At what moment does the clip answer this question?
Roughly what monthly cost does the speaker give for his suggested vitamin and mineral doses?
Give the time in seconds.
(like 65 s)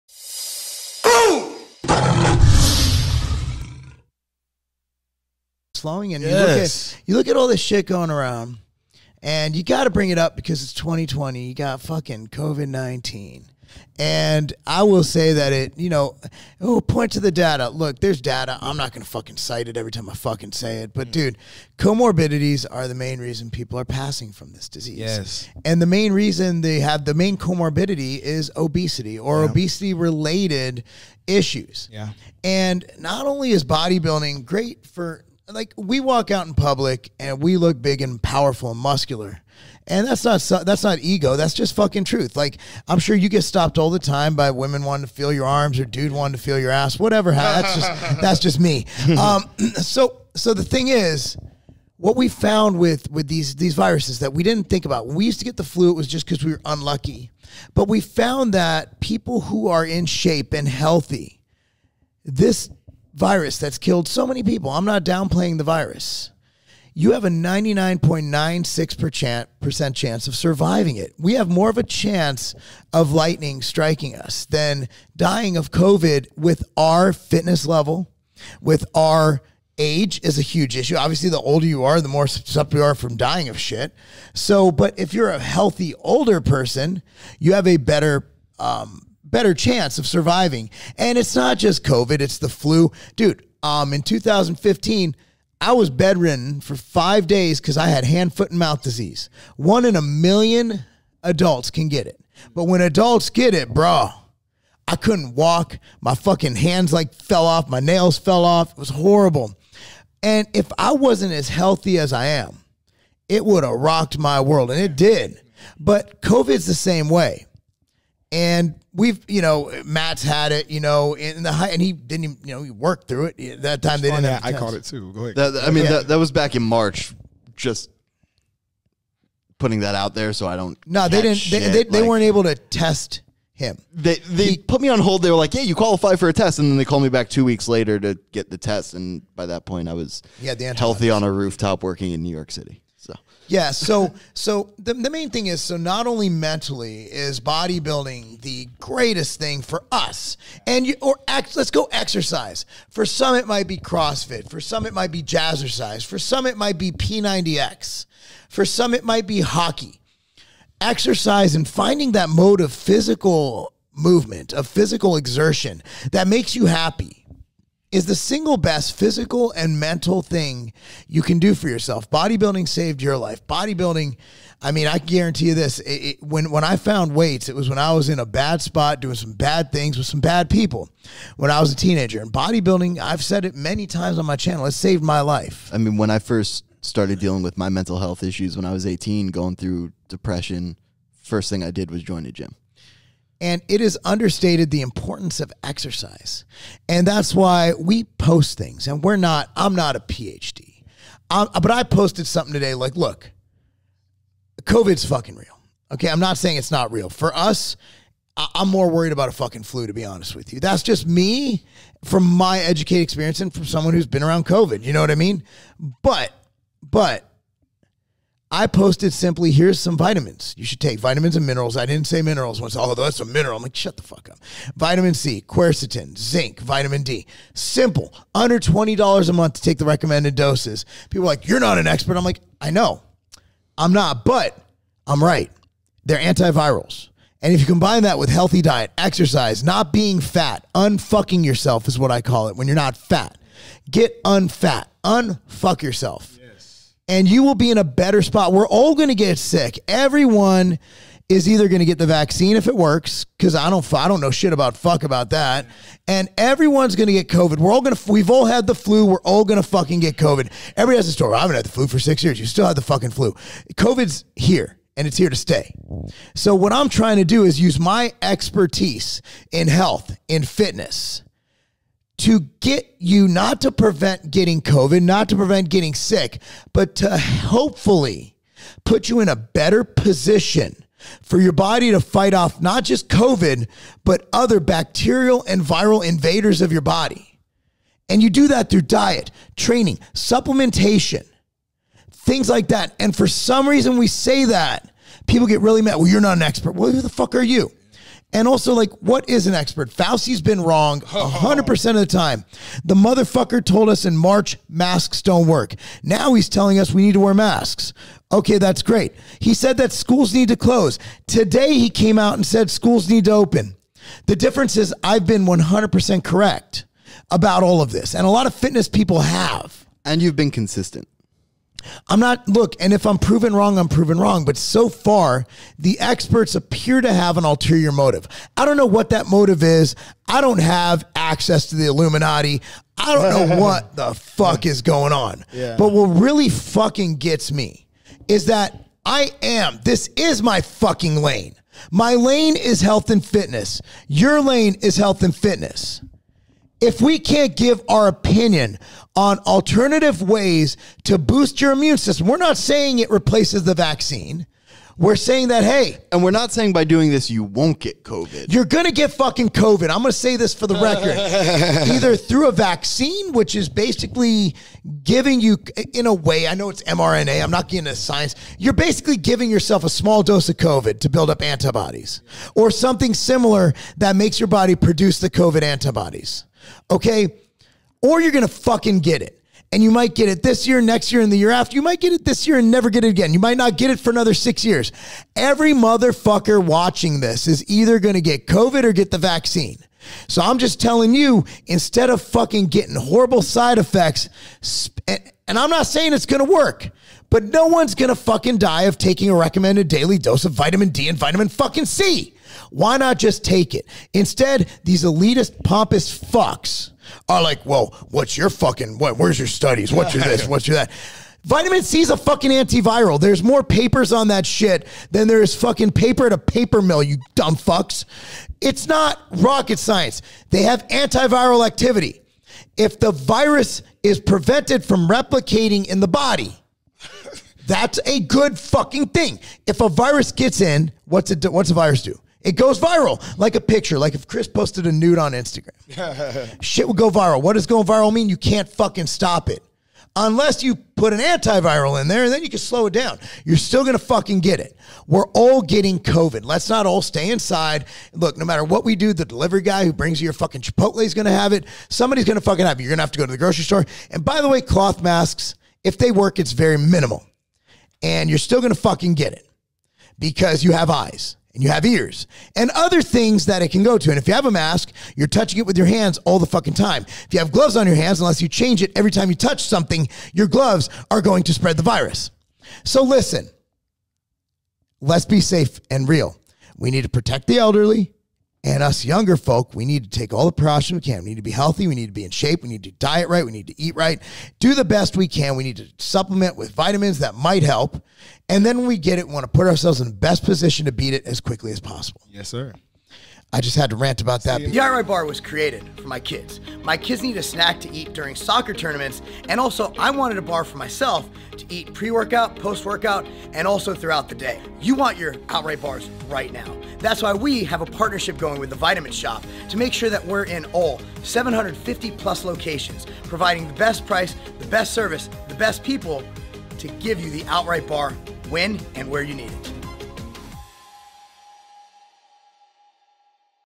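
228 s.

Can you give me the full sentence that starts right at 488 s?
And then when we get it, we want to put ourselves in the best position to beat it as quickly as possible.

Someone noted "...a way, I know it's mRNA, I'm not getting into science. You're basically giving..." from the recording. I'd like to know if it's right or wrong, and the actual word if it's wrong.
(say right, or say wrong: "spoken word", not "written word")
right.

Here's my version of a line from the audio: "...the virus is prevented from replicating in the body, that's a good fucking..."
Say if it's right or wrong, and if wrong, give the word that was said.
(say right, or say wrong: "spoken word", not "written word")
right.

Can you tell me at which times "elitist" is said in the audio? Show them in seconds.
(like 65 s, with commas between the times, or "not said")
405 s.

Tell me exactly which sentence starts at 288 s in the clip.
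And you do that through diet, training, supplementation, things like that.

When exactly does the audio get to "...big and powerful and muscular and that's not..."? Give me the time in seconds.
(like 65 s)
37 s.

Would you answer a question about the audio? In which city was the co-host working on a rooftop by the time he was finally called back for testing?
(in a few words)
New York City.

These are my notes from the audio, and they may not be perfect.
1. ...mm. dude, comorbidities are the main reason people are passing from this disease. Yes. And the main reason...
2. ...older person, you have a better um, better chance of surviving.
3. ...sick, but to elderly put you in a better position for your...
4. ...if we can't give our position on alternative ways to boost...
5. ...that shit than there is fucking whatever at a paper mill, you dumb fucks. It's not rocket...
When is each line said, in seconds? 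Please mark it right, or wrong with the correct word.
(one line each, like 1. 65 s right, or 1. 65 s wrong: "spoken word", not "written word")
1. 21 s right
2. 85 s right
3. 275 s wrong: "hopefully", not "elderly"
4. 346 s wrong: "opinion", not "position"
5. 414 s wrong: "paper", not "whatever".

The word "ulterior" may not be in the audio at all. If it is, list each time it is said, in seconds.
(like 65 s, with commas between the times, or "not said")
327 s.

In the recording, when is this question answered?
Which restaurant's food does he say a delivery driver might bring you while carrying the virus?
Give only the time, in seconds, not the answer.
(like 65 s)
450 s.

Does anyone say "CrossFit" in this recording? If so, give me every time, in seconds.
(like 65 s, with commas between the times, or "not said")
153 s.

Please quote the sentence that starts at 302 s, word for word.
The motherfucker told us in March masks don't work.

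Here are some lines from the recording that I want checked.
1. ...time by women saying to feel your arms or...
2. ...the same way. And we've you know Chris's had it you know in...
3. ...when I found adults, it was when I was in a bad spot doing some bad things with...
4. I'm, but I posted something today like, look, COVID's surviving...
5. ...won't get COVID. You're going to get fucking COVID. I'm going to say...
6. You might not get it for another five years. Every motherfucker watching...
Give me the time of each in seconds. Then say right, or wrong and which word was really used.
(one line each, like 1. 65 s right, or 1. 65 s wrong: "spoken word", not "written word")
1. 43 s wrong: "wanting", not "saying"
2. 116 s wrong: "Matt", not "Chris"
3. 176 s wrong: "weights", not "adults"
4. 201 s wrong: "fucking", not "surviving"
5. 357 s right
6. 383 s wrong: "six", not "five".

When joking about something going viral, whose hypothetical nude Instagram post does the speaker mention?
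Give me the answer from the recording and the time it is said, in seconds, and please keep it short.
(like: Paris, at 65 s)
Chris, at 434 s.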